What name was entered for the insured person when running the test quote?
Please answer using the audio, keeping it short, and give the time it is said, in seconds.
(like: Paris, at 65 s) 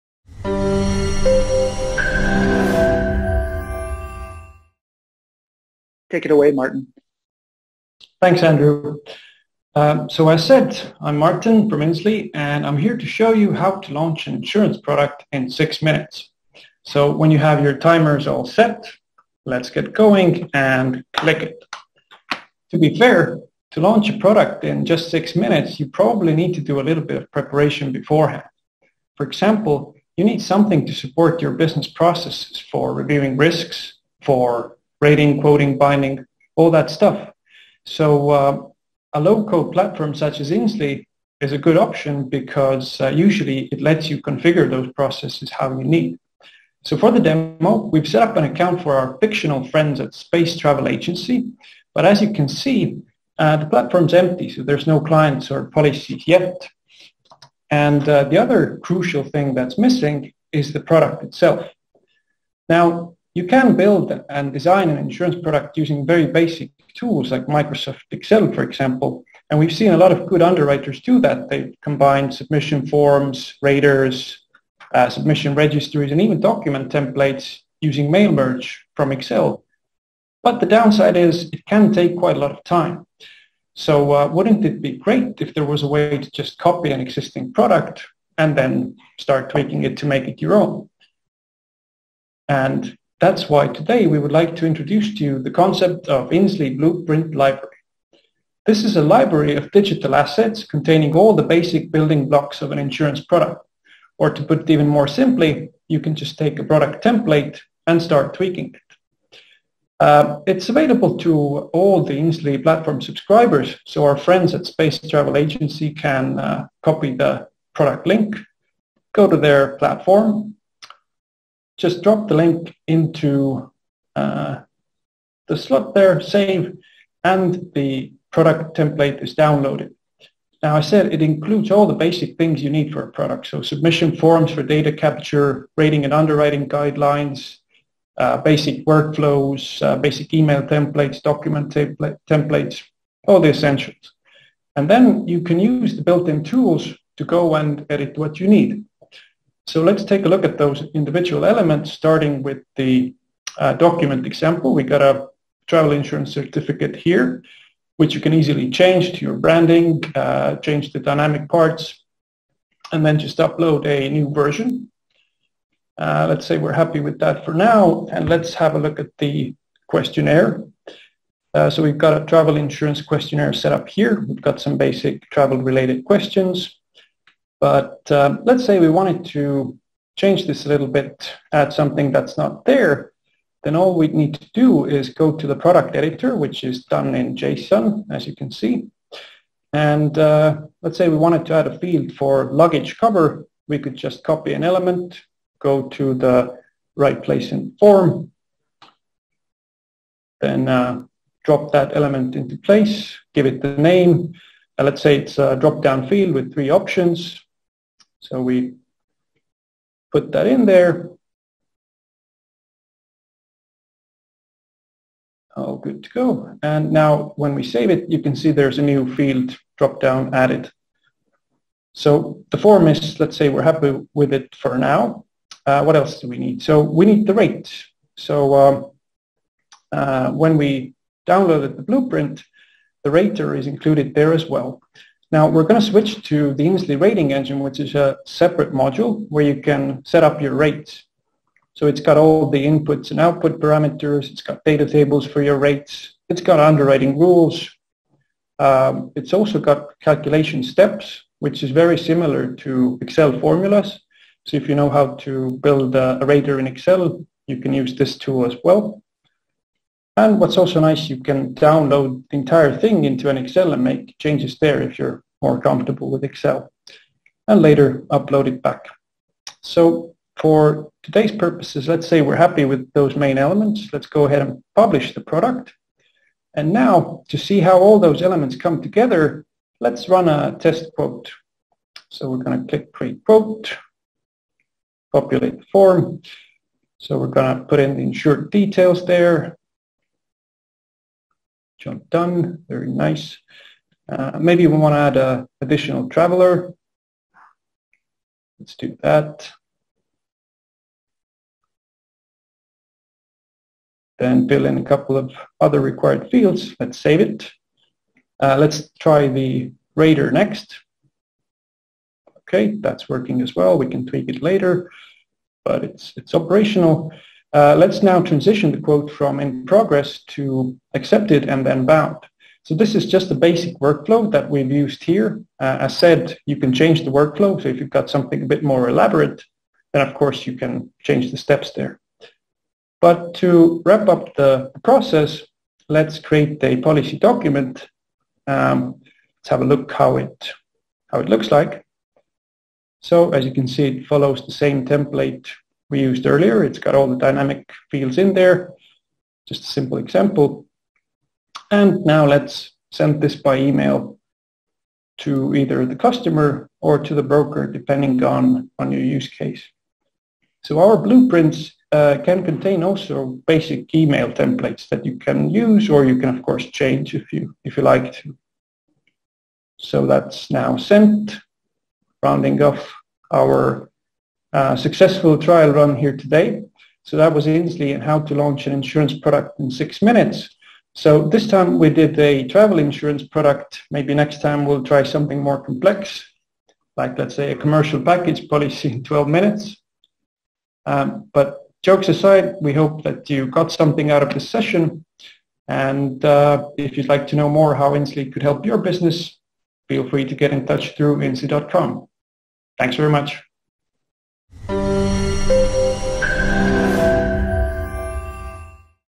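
John Dunn, at 291 s.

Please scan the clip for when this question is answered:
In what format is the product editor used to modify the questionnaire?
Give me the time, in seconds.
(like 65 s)
187 s.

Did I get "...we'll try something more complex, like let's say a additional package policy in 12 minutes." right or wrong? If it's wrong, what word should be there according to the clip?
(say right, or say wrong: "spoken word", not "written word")
wrong: "commercial", not "additional".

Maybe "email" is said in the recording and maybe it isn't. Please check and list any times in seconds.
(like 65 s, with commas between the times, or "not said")
140 s, 353 s, 363 s.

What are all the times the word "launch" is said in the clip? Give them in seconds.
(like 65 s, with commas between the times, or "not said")
13 s, 23 s, 378 s.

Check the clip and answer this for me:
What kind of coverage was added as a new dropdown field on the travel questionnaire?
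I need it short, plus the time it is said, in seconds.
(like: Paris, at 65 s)
luggage cover, at 192 s.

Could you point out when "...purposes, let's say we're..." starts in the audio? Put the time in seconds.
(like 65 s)
271 s.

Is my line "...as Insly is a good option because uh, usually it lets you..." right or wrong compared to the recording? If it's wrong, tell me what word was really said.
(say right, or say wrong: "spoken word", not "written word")
right.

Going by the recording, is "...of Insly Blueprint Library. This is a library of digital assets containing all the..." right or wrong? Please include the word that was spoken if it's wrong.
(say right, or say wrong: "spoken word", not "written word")
right.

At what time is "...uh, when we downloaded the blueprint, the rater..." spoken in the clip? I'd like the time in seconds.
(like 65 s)
229 s.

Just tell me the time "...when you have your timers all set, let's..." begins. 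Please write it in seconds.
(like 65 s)
17 s.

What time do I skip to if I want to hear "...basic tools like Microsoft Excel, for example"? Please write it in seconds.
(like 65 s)
66 s.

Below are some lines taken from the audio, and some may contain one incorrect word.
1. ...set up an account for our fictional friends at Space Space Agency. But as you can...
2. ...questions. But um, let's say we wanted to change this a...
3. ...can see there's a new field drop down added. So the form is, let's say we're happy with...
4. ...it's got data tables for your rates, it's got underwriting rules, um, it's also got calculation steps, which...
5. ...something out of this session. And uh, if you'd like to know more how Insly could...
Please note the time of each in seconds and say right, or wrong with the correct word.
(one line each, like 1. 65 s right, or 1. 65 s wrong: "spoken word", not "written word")
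1. 48 s wrong: "Travel", not "Space"
2. 176 s right
3. 218 s right
4. 244 s right
5. 393 s right.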